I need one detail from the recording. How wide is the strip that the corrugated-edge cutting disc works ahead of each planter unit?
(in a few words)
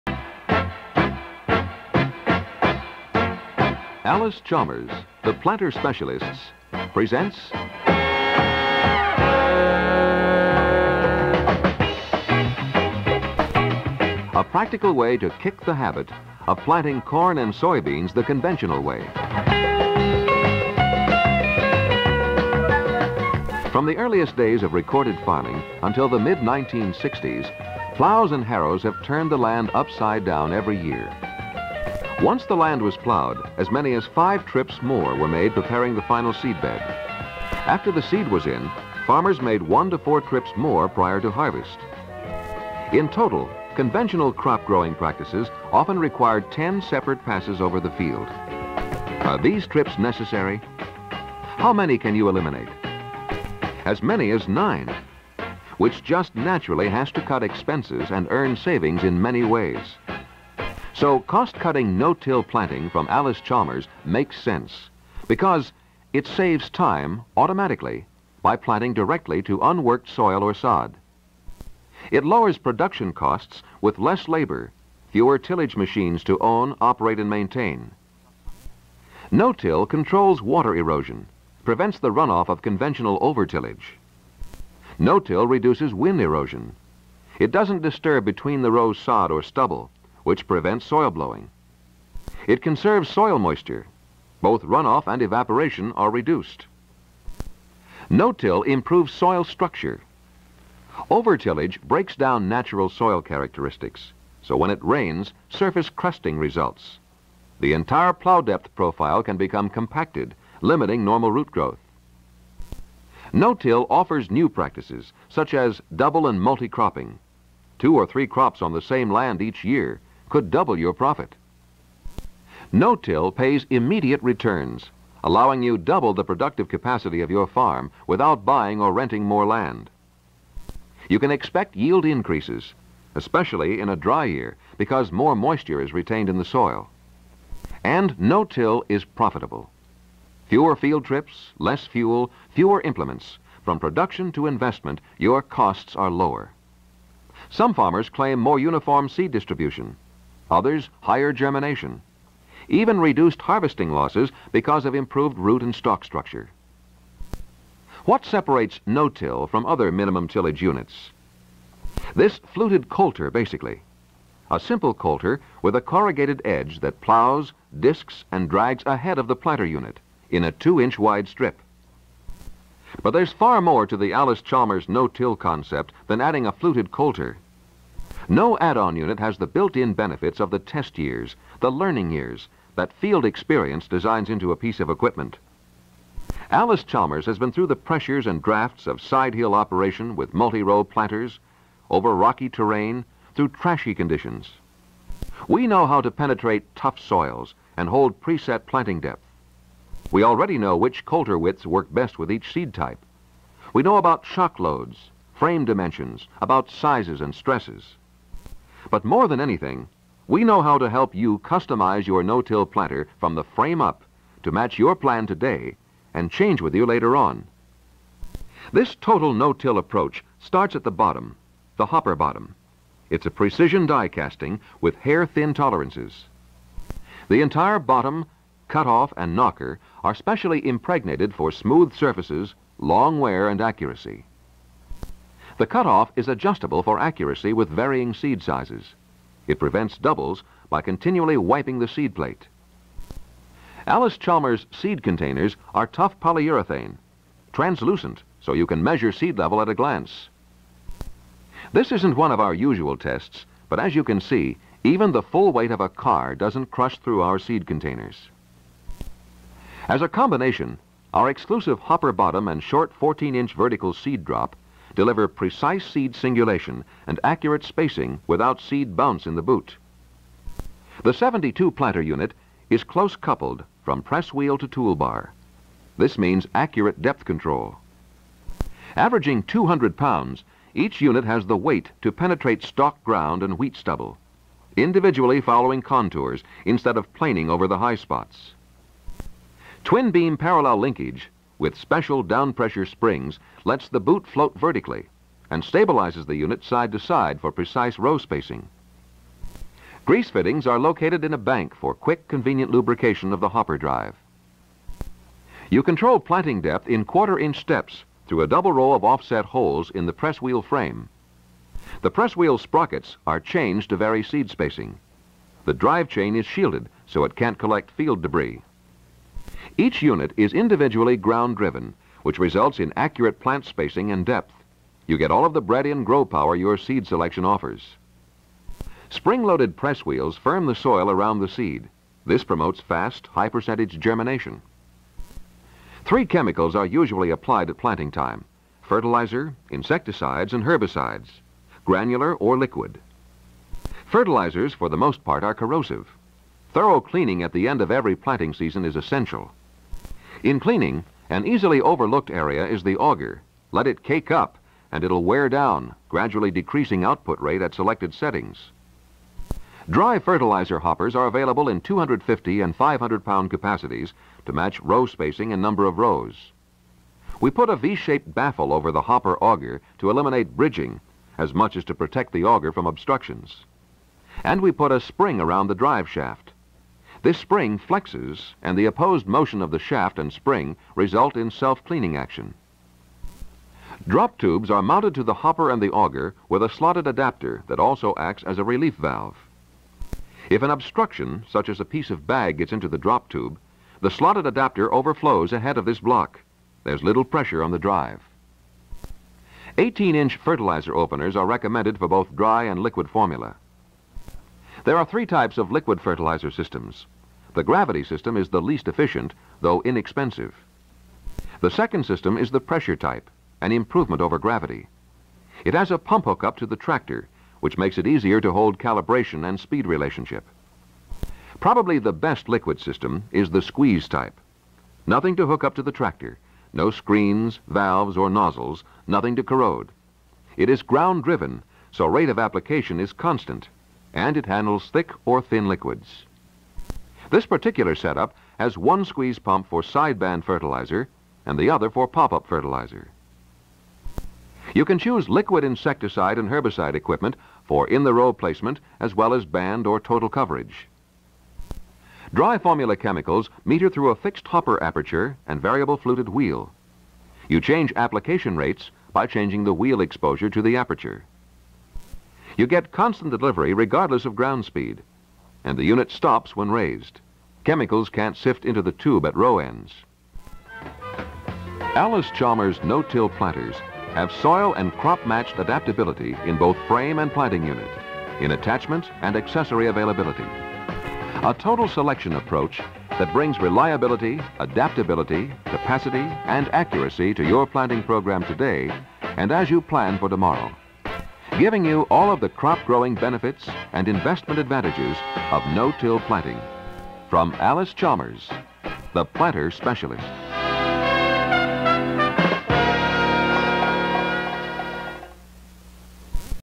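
two-inch.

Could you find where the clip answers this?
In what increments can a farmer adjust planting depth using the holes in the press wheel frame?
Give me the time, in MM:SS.
05:07.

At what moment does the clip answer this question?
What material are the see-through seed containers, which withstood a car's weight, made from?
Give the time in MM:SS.
04:06.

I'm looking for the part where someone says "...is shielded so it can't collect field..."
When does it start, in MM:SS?
05:16.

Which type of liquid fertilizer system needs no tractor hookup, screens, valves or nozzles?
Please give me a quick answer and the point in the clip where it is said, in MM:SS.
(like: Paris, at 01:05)
squeeze type, at 07:03.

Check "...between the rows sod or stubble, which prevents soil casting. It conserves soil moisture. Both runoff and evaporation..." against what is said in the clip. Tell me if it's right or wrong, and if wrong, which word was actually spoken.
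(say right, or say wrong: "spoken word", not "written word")
wrong: "blowing", not "casting".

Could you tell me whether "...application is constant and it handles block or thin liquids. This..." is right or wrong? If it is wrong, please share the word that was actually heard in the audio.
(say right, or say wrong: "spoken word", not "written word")
wrong: "thick", not "block".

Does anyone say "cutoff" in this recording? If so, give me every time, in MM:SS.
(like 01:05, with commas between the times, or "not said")
03:48, 03:55.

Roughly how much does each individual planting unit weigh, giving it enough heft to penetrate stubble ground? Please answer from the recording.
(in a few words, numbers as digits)
200 pounds.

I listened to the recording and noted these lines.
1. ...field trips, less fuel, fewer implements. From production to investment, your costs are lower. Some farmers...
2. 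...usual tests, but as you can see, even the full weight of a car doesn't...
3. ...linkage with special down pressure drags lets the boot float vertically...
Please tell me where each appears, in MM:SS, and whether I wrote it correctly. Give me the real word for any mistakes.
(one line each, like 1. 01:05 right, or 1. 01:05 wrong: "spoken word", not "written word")
1. 02:20 right
2. 04:12 right
3. 04:50 wrong: "springs", not "drags".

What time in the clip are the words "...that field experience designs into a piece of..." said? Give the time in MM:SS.
03:02.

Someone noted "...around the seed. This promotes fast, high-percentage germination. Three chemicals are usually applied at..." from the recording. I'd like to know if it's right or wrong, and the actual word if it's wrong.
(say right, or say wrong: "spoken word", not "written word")
right.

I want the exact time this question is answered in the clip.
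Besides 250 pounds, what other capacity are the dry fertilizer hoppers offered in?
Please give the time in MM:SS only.
06:02.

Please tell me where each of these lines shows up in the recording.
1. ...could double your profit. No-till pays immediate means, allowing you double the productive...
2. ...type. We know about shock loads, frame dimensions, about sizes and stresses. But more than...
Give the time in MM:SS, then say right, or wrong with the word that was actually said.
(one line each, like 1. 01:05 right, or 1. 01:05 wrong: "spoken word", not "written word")
1. 02:00 wrong: "returns", not "means"
2. 03:22 right.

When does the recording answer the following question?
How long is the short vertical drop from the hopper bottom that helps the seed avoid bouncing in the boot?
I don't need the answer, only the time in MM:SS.
04:22.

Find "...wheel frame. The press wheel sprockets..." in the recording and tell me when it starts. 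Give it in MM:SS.
05:10.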